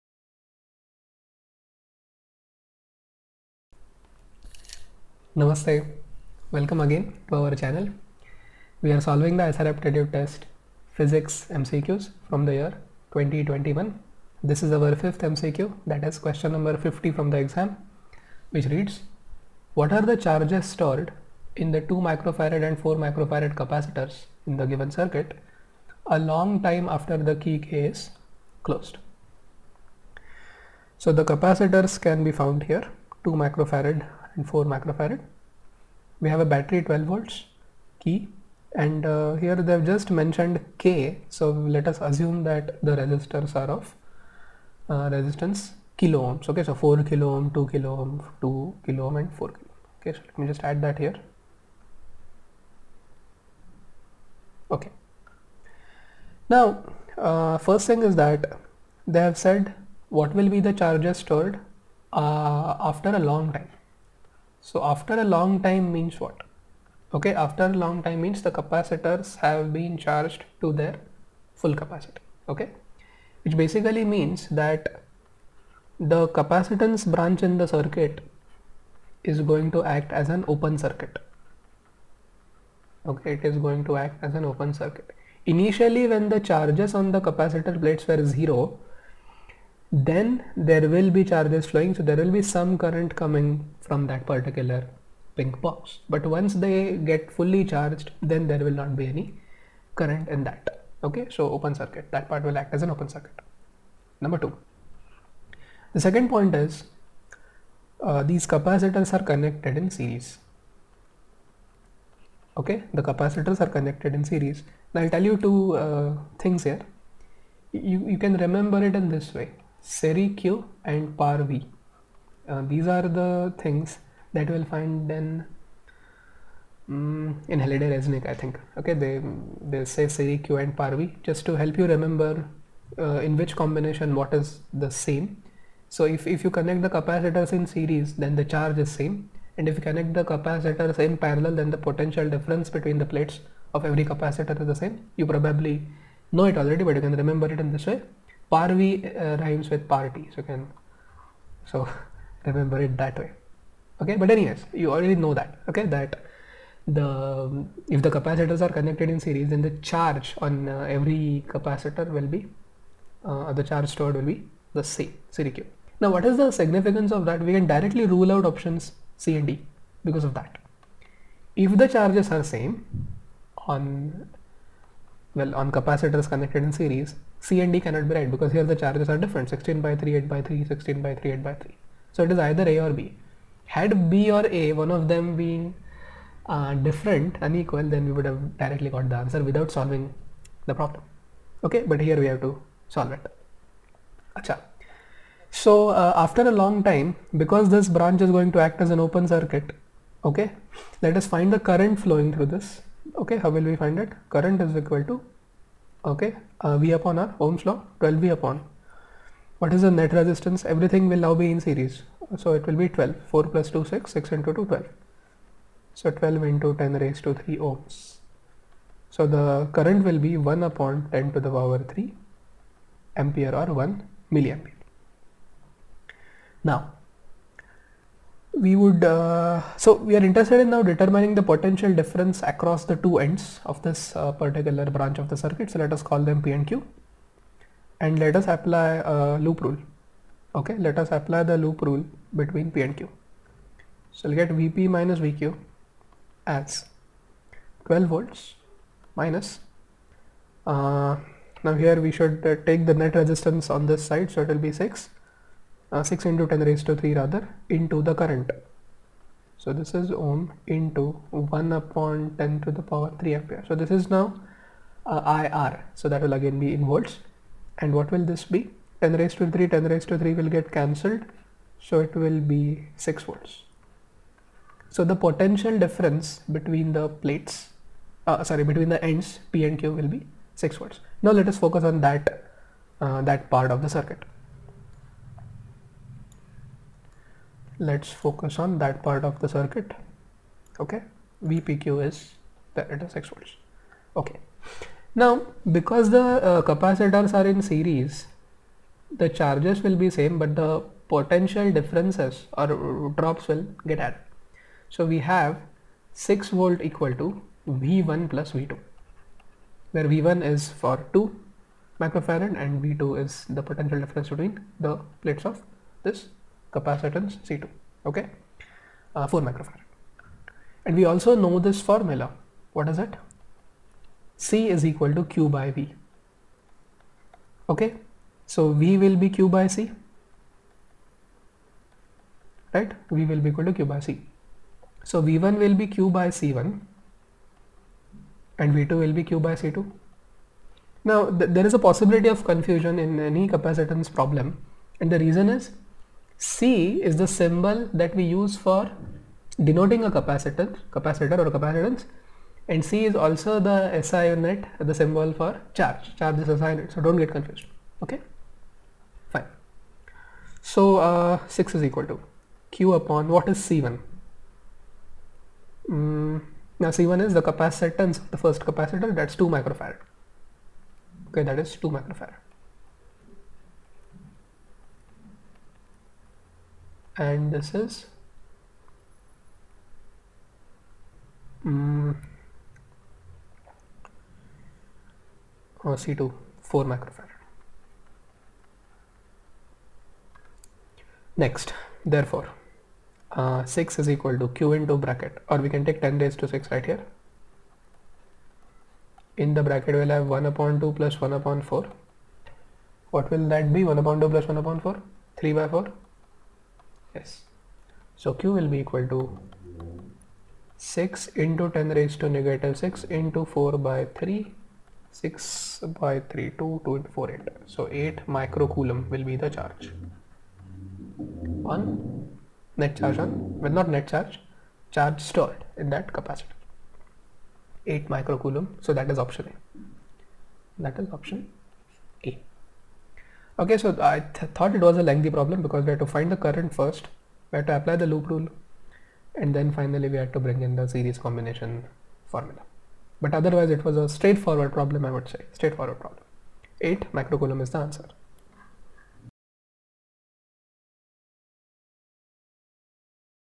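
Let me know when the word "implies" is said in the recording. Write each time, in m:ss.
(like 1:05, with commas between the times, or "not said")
not said.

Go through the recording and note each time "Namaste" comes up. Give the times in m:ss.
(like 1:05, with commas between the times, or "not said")
0:05.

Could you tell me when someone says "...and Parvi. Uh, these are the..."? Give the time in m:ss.
2:00.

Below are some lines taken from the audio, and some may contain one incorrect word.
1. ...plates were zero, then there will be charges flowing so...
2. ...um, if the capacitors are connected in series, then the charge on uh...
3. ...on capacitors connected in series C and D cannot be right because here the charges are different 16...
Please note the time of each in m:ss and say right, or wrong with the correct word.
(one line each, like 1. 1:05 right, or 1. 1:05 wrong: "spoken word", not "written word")
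1. 1:27 right
2. 2:37 right
3. 2:55 right.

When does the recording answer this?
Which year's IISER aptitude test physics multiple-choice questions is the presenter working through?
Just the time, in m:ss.
0:13.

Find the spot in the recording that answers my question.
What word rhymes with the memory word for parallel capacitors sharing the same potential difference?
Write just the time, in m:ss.
2:29.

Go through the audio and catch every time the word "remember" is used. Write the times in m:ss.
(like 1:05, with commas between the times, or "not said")
1:58, 2:11, 2:27, 2:32.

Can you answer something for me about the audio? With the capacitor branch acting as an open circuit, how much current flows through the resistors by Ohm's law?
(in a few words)
1 milliampere.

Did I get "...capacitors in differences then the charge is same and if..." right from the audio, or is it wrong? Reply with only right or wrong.
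wrong.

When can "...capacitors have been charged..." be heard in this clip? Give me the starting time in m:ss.
1:08.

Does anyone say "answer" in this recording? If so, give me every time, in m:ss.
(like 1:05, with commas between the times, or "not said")
3:09, 7:27.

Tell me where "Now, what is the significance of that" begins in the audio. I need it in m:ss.
2:46.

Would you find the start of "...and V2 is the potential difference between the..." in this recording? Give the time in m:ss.
5:12.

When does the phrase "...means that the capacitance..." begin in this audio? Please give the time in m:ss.
1:14.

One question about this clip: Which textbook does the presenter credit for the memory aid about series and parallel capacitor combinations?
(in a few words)
Halliday Resnick.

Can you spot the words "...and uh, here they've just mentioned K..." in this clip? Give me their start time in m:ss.
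0:38.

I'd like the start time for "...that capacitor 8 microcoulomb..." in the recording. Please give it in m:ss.
7:05.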